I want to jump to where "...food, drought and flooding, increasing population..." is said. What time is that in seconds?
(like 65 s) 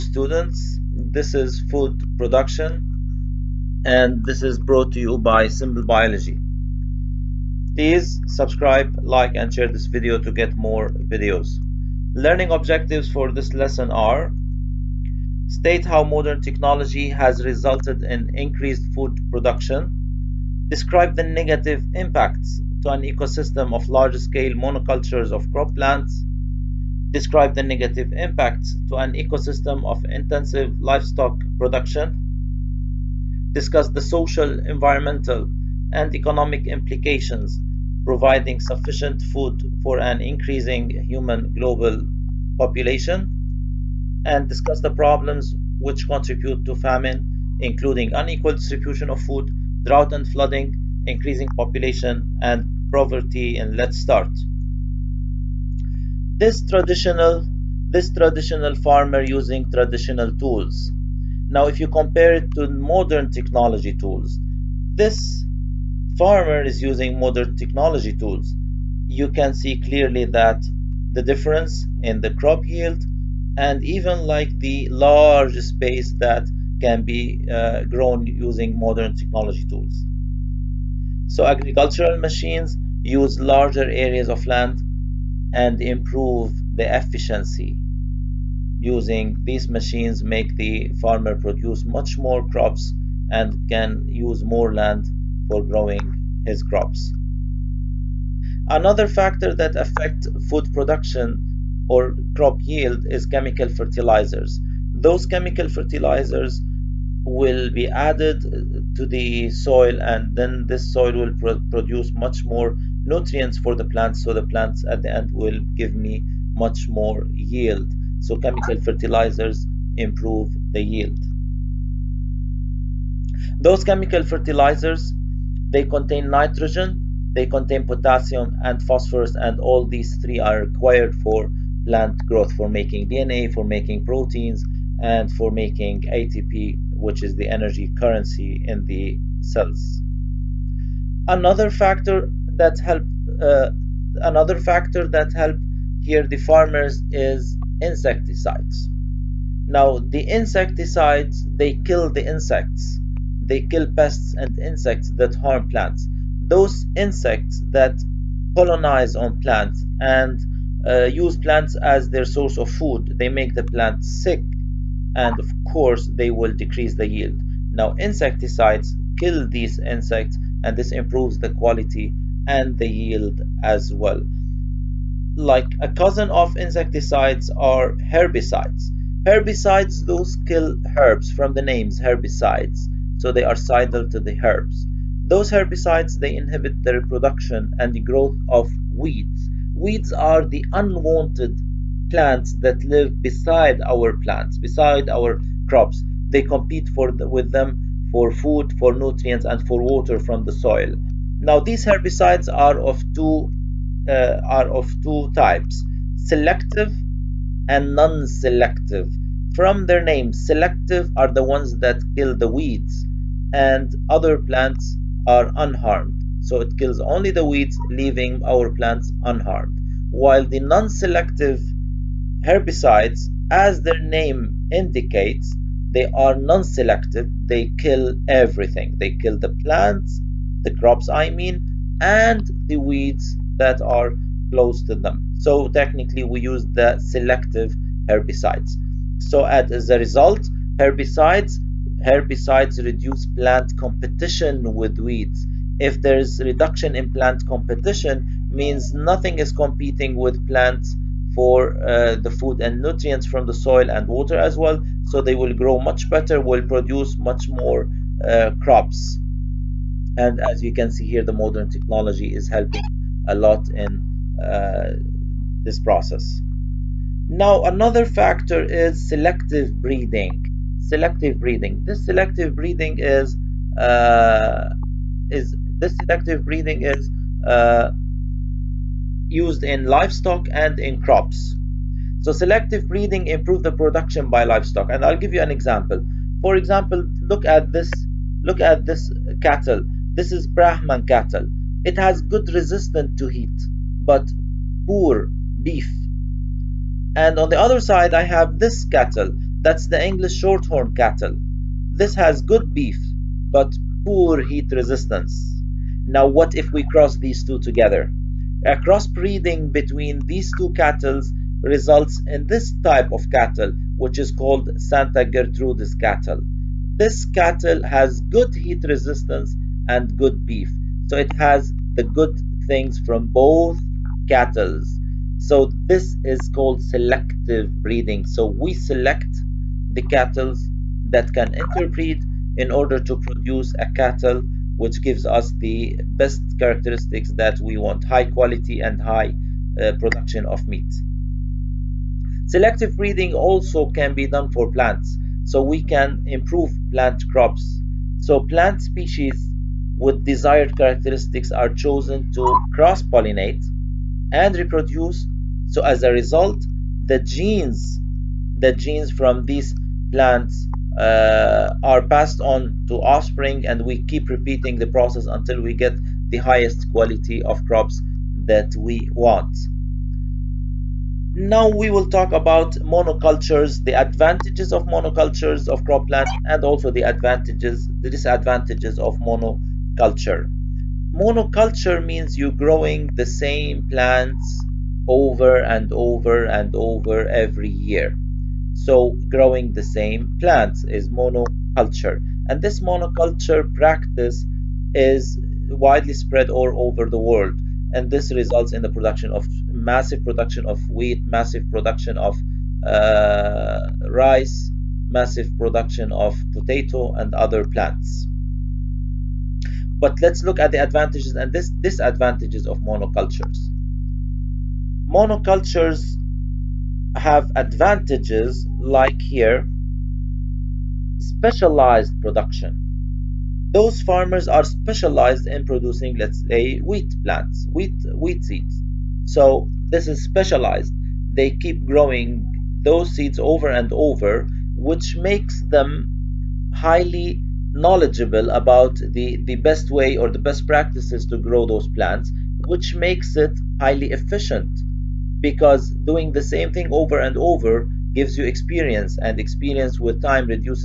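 49 s.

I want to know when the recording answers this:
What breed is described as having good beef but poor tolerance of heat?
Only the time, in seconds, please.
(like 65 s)
300 s.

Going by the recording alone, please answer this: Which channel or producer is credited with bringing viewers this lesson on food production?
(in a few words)
Simple Biology.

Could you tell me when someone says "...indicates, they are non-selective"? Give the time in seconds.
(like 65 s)
224 s.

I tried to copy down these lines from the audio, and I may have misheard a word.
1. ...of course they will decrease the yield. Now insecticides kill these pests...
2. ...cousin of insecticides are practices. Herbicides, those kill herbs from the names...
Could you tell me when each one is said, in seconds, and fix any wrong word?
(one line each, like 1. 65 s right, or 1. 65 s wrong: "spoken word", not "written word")
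1. 165 s wrong: "insects", not "pests"
2. 175 s wrong: "herbicides", not "practices".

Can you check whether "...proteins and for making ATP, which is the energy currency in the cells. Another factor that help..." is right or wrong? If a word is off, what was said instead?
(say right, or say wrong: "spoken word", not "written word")
right.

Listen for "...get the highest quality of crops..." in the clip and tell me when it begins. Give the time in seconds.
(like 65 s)
365 s.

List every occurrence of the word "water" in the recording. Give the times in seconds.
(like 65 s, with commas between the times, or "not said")
199 s, 254 s.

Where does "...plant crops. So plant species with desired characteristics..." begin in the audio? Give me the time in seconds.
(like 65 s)
346 s.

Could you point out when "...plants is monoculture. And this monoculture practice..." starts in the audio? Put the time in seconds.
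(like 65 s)
390 s.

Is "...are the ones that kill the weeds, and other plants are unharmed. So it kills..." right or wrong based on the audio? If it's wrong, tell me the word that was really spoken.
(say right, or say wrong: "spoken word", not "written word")
right.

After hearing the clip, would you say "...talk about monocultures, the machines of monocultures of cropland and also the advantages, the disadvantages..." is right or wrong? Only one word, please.
wrong.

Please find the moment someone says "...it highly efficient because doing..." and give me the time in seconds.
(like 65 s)
443 s.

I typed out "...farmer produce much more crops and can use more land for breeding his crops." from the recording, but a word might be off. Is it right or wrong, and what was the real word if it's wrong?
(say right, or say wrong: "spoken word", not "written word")
wrong: "growing", not "breeding".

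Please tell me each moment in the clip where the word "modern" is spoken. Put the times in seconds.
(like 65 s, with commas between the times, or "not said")
16 s, 62 s, 67 s, 78 s, 261 s.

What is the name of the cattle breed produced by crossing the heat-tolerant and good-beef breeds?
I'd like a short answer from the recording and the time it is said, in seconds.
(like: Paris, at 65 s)
Santa Gertrudis, at 314 s.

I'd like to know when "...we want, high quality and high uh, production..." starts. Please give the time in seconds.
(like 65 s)
337 s.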